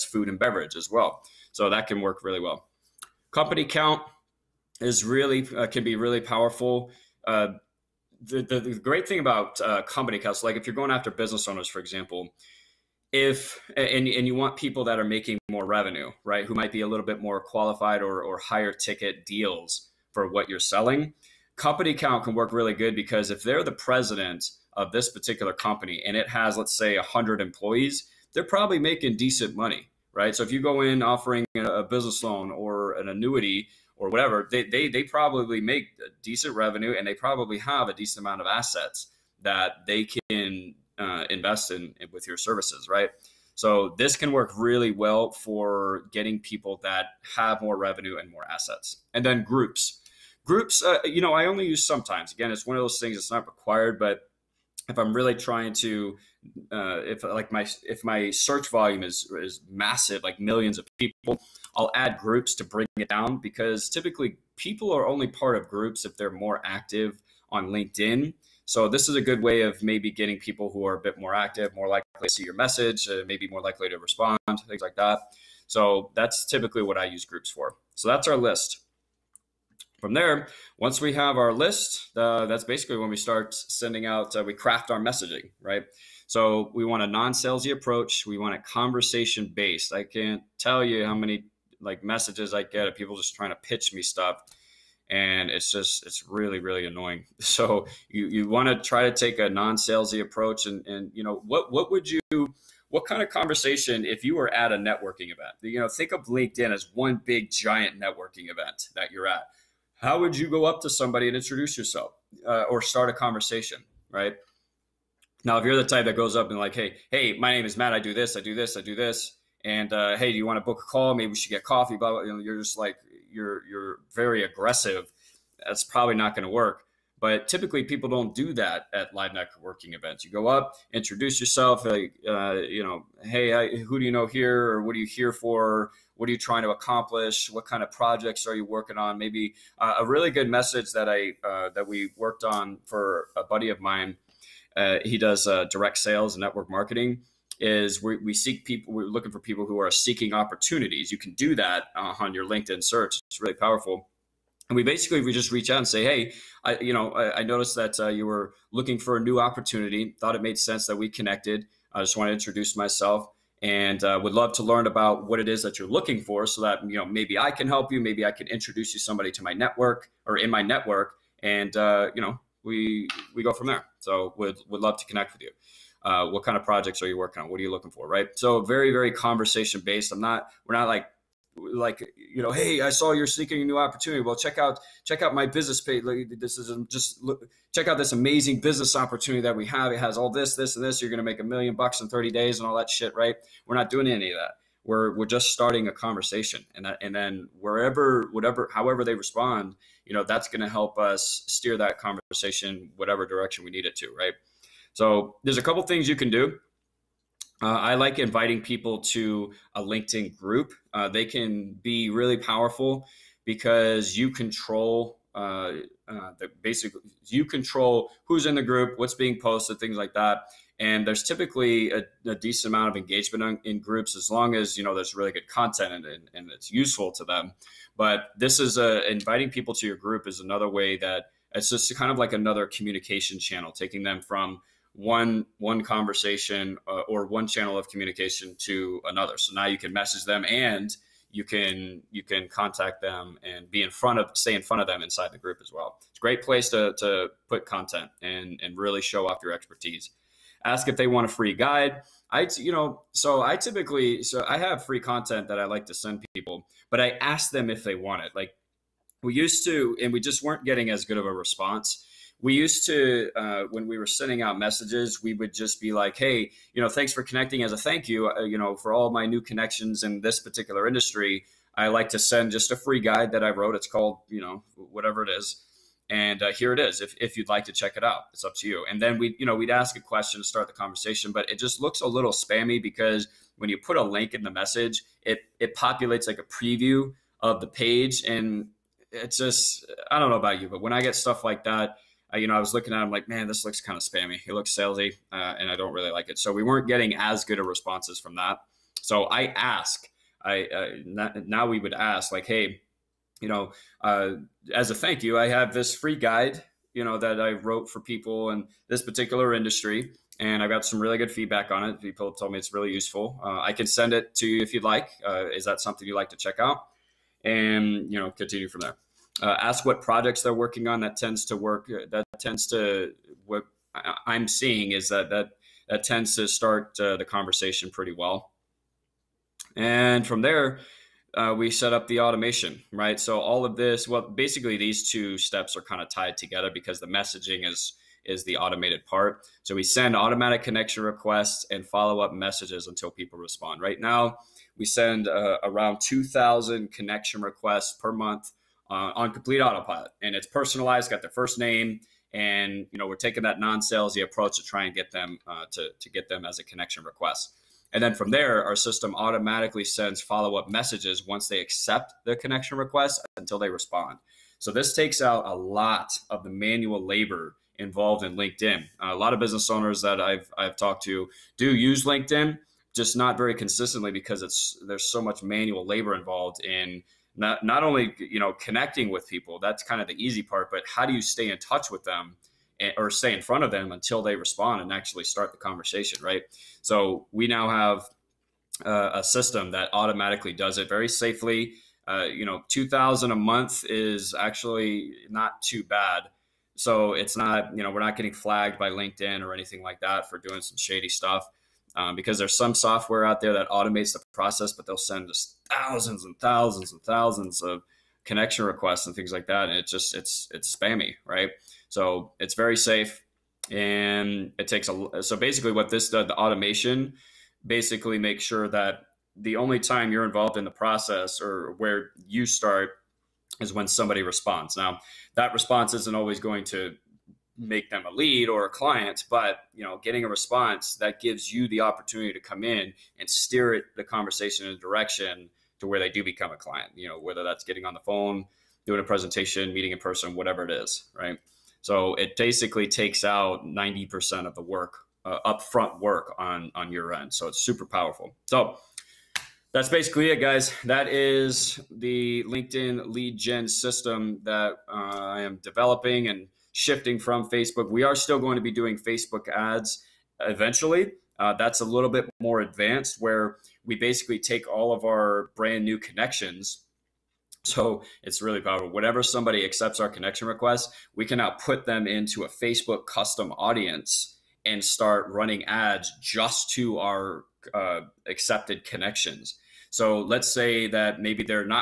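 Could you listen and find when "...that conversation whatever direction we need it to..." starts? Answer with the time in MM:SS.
03:21.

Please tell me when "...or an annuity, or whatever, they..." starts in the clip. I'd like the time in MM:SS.
00:32.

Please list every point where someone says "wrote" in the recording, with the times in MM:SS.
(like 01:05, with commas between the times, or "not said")
04:33, 05:07.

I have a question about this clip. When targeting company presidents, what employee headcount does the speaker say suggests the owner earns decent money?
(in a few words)
100.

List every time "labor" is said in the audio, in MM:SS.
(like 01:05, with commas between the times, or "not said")
06:07, 06:15.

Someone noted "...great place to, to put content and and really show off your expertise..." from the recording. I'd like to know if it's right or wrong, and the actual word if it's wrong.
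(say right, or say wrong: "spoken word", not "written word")
right.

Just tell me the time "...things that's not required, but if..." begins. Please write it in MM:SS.
00:52.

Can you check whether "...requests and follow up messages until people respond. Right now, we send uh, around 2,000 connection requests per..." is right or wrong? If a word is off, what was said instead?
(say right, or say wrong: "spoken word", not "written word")
right.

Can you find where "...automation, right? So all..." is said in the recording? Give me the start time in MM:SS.
05:32.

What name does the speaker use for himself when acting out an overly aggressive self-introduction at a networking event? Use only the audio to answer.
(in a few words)
Matt.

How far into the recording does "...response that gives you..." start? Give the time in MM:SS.
07:10.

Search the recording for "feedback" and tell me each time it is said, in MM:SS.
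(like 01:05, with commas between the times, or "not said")
05:11.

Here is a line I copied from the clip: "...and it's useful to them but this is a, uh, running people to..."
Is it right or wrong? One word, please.
wrong.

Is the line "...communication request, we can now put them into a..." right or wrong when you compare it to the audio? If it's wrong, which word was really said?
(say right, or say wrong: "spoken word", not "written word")
wrong: "connection", not "communication".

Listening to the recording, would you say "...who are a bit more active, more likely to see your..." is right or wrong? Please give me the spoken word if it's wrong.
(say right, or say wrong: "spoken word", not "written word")
right.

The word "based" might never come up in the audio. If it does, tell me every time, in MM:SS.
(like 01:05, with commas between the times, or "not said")
01:29, 02:59.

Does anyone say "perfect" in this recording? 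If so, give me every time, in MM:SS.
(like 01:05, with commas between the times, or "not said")
not said.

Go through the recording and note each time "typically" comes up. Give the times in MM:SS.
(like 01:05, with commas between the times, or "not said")
01:03, 01:16, 02:07, 03:41, 04:13.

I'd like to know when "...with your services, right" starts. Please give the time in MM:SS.
00:42.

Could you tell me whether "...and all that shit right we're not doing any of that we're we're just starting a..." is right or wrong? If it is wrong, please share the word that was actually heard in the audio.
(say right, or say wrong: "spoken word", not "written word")
right.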